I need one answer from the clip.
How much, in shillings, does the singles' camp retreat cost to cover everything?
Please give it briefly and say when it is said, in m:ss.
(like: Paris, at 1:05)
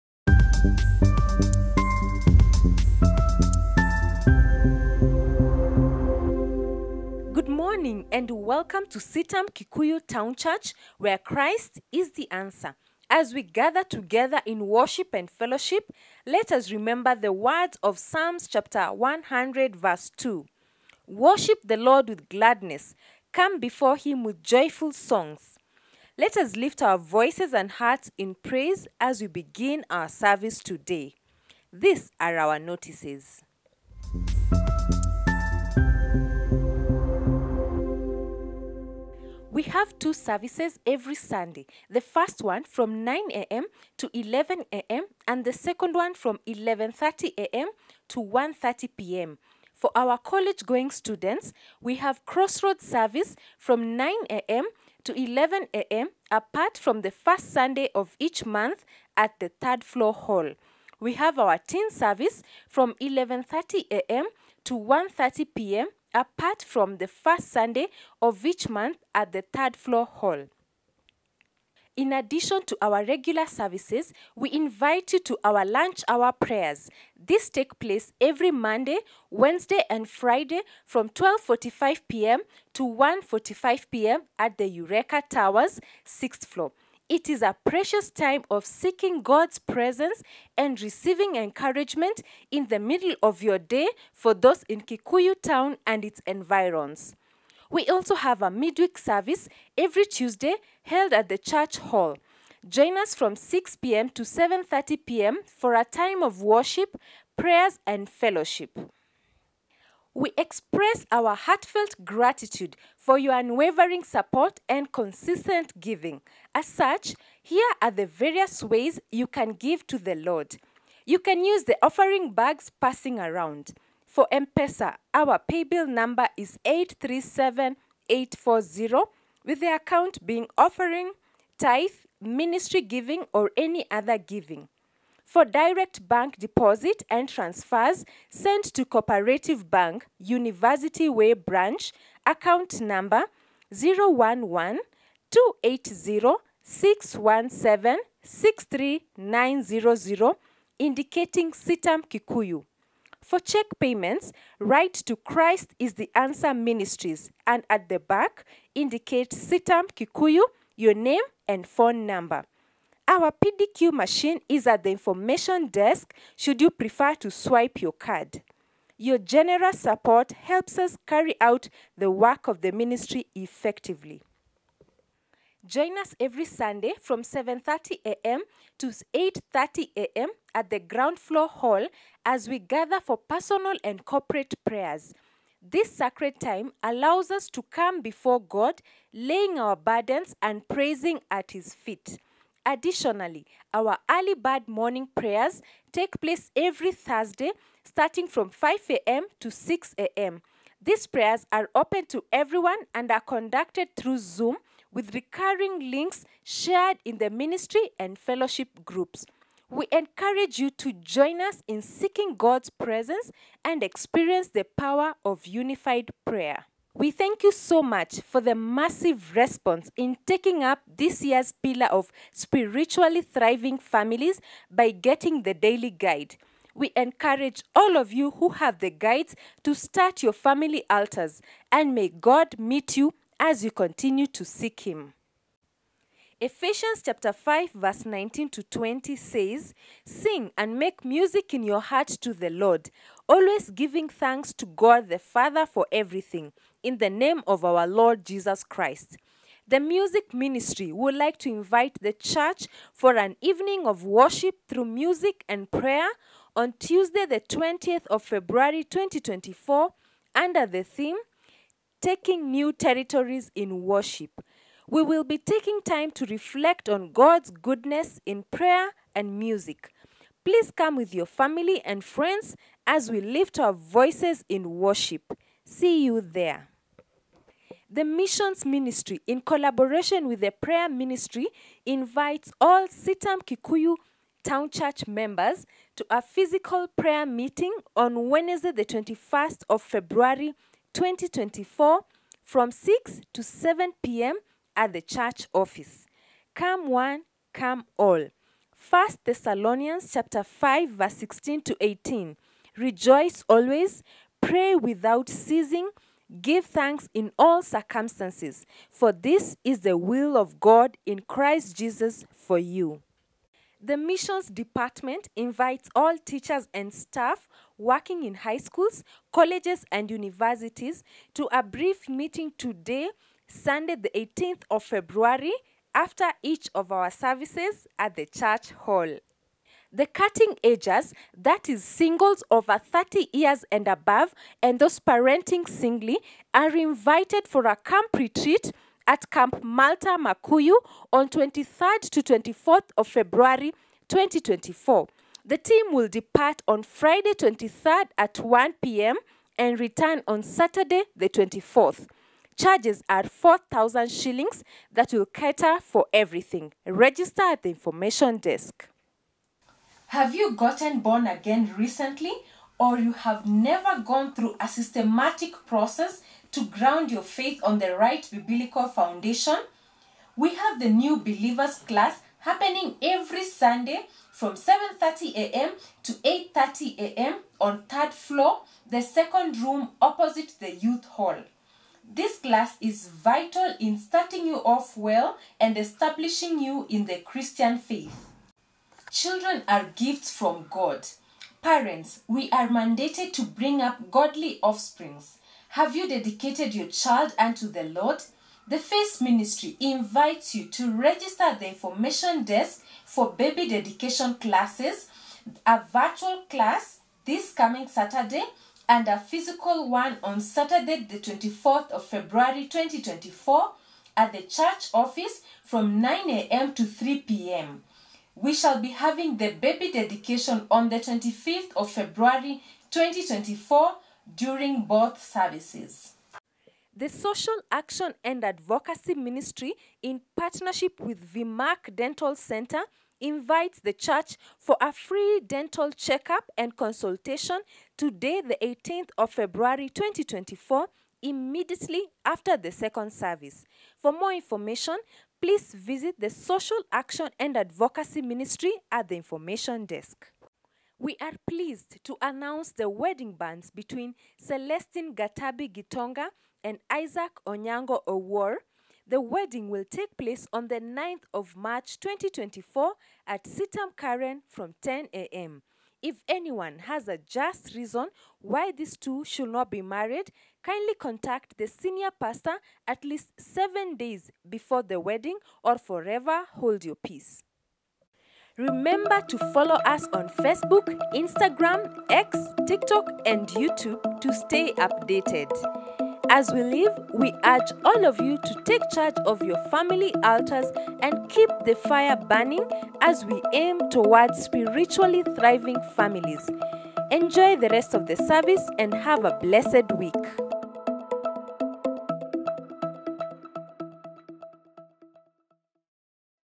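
4,000 shillings, at 5:53.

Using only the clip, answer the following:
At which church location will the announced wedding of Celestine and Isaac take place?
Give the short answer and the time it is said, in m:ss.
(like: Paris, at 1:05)
CITAM Karen, at 7:43.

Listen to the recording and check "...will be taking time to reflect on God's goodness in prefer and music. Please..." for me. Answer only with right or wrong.
wrong.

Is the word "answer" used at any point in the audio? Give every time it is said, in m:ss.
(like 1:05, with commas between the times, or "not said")
0:12, 2:36.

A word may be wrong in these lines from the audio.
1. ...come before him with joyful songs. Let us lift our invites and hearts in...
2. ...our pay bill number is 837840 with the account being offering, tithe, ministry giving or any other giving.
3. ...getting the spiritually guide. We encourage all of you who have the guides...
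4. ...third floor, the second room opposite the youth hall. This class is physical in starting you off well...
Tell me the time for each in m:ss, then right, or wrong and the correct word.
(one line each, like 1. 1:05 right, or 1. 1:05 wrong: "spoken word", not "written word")
1. 0:23 wrong: "voices", not "invites"
2. 2:05 right
3. 3:44 wrong: "daily", not "spiritually"
4. 6:17 wrong: "vital", not "physical".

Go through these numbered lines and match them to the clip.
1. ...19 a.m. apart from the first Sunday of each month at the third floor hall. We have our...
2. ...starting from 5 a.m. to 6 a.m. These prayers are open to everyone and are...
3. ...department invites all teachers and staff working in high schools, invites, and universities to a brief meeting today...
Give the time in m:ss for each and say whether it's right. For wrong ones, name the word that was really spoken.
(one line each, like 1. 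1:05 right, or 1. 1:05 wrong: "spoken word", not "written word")
1. 0:55 wrong: "11", not "19"
2. 3:17 right
3. 5:14 wrong: "colleges", not "invites".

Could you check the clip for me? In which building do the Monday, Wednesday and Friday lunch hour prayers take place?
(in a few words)
Eureka Towers.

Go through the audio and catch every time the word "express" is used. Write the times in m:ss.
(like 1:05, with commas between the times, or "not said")
1:50.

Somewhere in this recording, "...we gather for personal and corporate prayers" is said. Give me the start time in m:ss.
3:02.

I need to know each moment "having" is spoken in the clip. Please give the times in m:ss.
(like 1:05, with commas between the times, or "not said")
6:58.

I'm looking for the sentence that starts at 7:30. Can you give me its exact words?
We are pleased to announce the wedding bands between Celestine Gatabi Gitonga and Isaac Onyango Owor.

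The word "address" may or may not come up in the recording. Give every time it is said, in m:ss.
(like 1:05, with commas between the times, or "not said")
not said.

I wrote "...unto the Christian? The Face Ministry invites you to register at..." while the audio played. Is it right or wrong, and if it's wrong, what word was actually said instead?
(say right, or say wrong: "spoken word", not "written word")
wrong: "Lord", not "Christian".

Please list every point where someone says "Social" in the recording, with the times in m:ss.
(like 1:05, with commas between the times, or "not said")
7:07, 7:26.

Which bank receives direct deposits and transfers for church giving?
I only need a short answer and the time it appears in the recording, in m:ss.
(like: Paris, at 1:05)
Cooperative Bank, at 2:18.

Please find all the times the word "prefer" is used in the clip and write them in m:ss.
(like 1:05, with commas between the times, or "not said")
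2:46.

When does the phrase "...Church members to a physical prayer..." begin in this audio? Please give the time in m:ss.
4:44.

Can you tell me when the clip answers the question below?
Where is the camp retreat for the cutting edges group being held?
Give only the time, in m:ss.
5:39.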